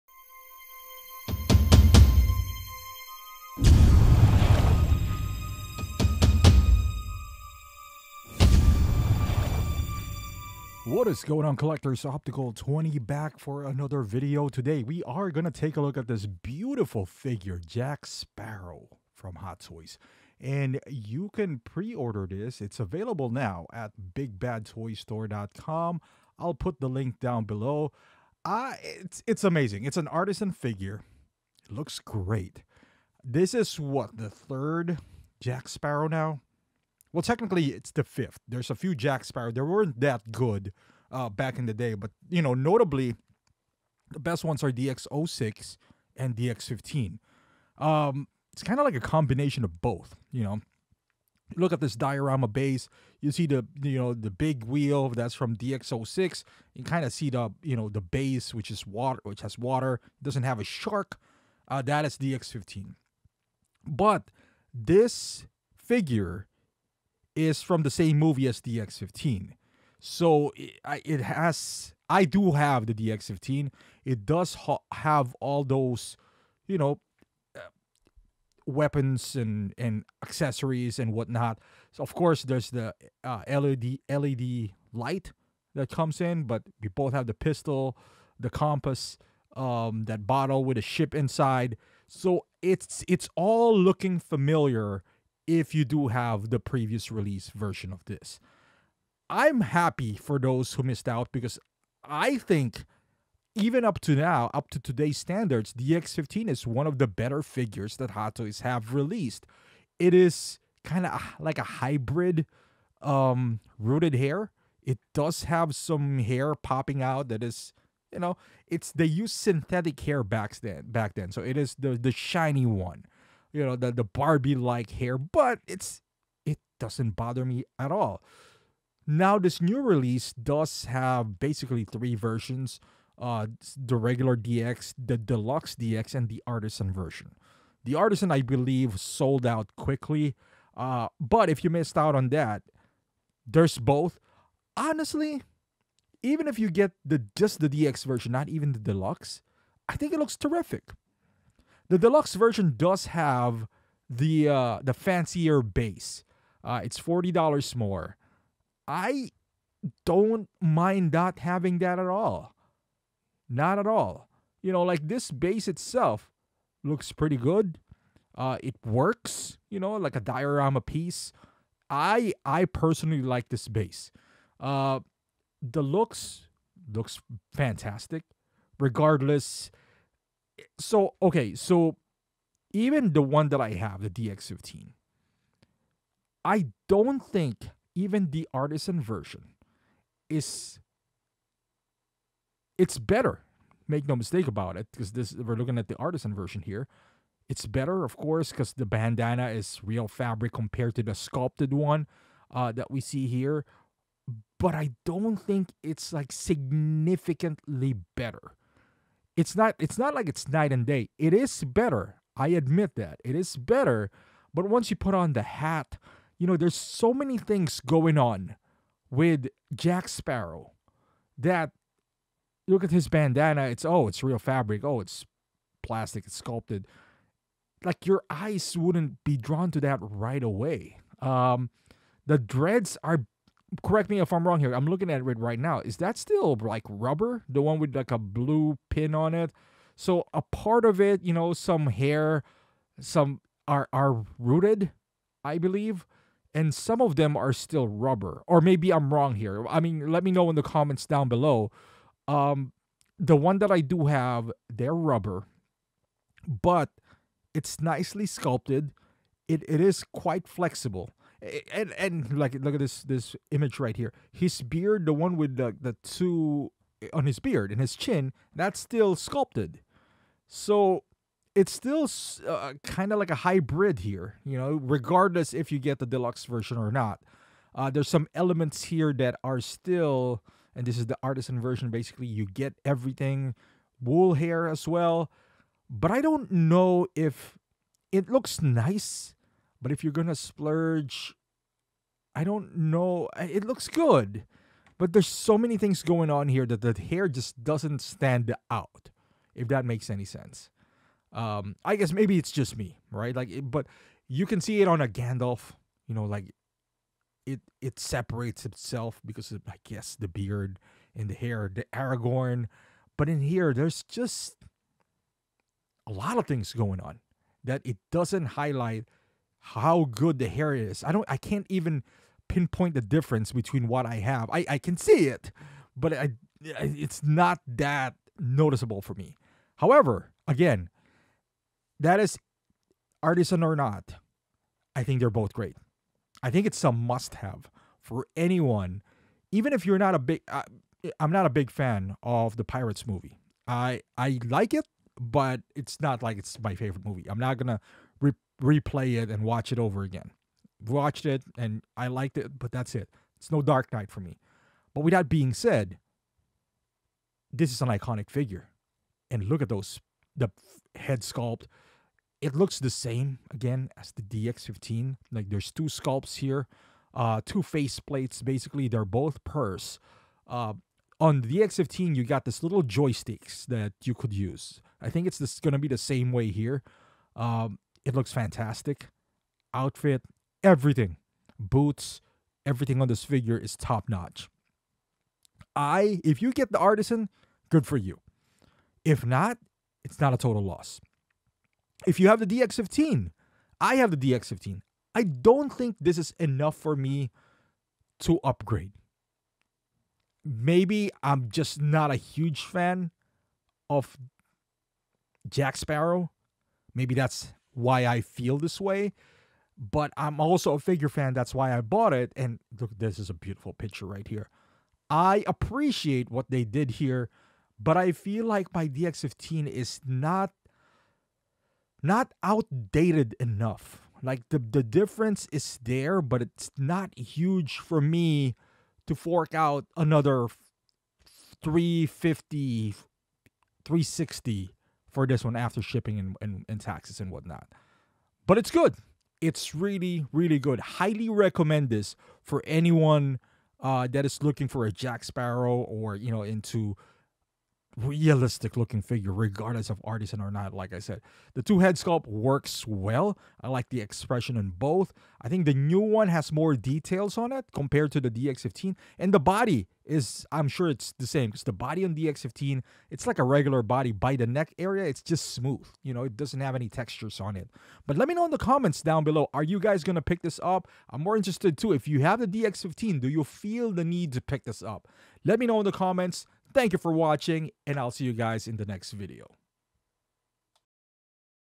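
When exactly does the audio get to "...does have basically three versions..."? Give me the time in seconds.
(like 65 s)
130 s.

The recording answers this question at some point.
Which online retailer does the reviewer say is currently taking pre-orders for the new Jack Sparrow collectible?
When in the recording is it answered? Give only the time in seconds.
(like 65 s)
24 s.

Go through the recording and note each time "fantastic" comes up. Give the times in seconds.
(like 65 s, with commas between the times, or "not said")
177 s, 378 s.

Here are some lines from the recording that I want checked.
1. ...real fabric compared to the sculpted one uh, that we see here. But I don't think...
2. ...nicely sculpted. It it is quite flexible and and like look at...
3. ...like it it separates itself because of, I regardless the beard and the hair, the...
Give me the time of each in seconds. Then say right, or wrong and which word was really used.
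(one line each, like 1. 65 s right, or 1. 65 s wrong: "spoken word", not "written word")
1. 199 s right
2. 257 s right
3. 306 s wrong: "guess", not "regardless".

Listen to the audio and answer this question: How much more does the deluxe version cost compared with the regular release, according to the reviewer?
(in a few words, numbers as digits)
$40.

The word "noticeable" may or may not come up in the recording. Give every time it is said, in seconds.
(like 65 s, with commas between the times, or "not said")
328 s.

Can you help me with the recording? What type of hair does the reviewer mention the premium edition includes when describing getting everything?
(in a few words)
wool hair.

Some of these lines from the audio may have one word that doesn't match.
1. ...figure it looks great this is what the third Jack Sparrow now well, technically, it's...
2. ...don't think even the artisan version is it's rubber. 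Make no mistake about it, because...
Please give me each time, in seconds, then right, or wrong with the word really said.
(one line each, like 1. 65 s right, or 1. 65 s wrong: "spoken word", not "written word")
1. 30 s right
2. 186 s wrong: "better", not "rubber".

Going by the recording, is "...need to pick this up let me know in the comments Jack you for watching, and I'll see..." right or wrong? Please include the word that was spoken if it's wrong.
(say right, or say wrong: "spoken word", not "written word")
wrong: "Thank", not "Jack".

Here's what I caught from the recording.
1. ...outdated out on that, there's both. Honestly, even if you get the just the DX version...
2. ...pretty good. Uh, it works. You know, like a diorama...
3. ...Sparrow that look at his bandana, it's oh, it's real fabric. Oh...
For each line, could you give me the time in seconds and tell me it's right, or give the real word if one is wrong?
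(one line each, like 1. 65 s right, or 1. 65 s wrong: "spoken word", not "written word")
1. 141 s wrong: "missed", not "outdated"
2. 167 s right
3. 220 s right.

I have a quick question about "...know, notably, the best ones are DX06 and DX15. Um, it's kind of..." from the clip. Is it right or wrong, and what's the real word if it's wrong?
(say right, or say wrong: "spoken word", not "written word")
right.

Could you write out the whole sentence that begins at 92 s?
So it's it's all looking familiar if you do have the previous release version of this.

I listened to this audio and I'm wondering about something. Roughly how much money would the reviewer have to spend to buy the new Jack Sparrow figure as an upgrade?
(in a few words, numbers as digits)
350.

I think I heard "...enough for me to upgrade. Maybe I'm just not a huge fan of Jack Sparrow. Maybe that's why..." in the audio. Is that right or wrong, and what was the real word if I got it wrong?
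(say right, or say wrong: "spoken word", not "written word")
right.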